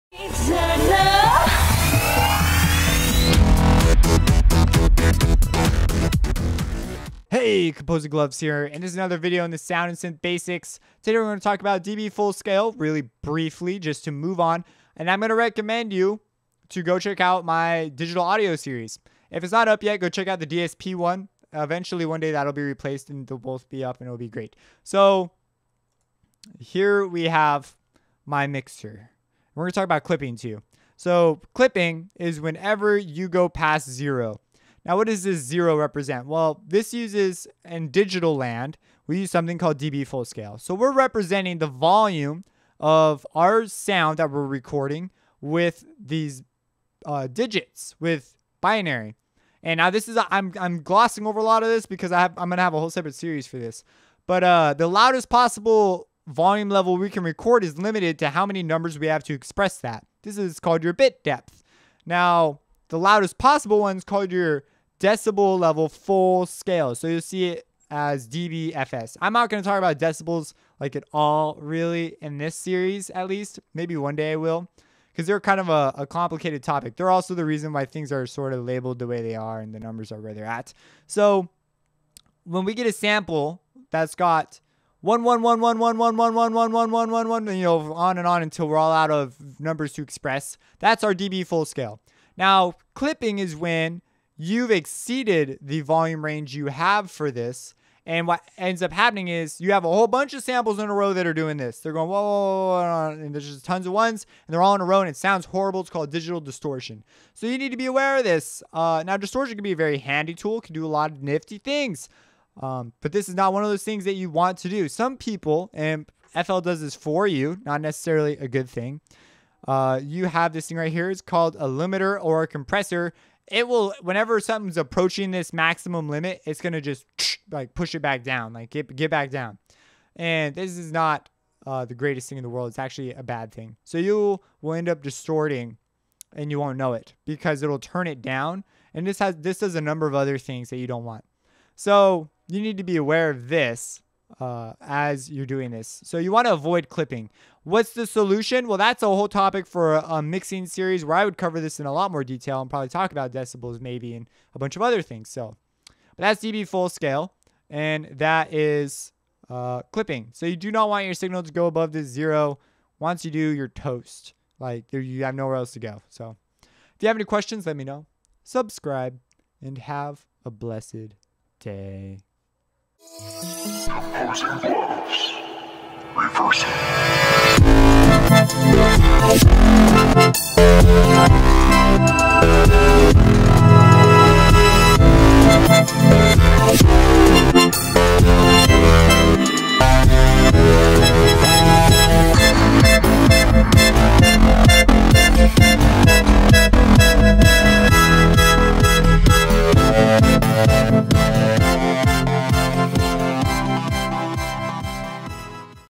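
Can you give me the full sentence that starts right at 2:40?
So you do not want your signal to go above this zero.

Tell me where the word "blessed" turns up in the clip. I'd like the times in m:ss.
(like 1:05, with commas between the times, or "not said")
2:50.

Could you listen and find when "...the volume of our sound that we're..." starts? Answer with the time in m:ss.
0:41.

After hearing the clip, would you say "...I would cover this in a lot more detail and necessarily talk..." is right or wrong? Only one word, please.
wrong.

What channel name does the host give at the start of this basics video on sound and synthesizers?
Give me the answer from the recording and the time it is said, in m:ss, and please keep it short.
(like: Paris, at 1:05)
Composing Gloves, at 0:07.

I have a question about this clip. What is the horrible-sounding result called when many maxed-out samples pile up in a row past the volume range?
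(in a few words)
Digital distortion.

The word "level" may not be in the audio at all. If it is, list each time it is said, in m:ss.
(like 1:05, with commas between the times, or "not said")
0:56, 1:05.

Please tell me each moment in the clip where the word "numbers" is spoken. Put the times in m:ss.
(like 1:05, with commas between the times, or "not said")
0:58, 1:19, 1:29, 2:19.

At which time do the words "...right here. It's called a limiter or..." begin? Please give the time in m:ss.
2:00.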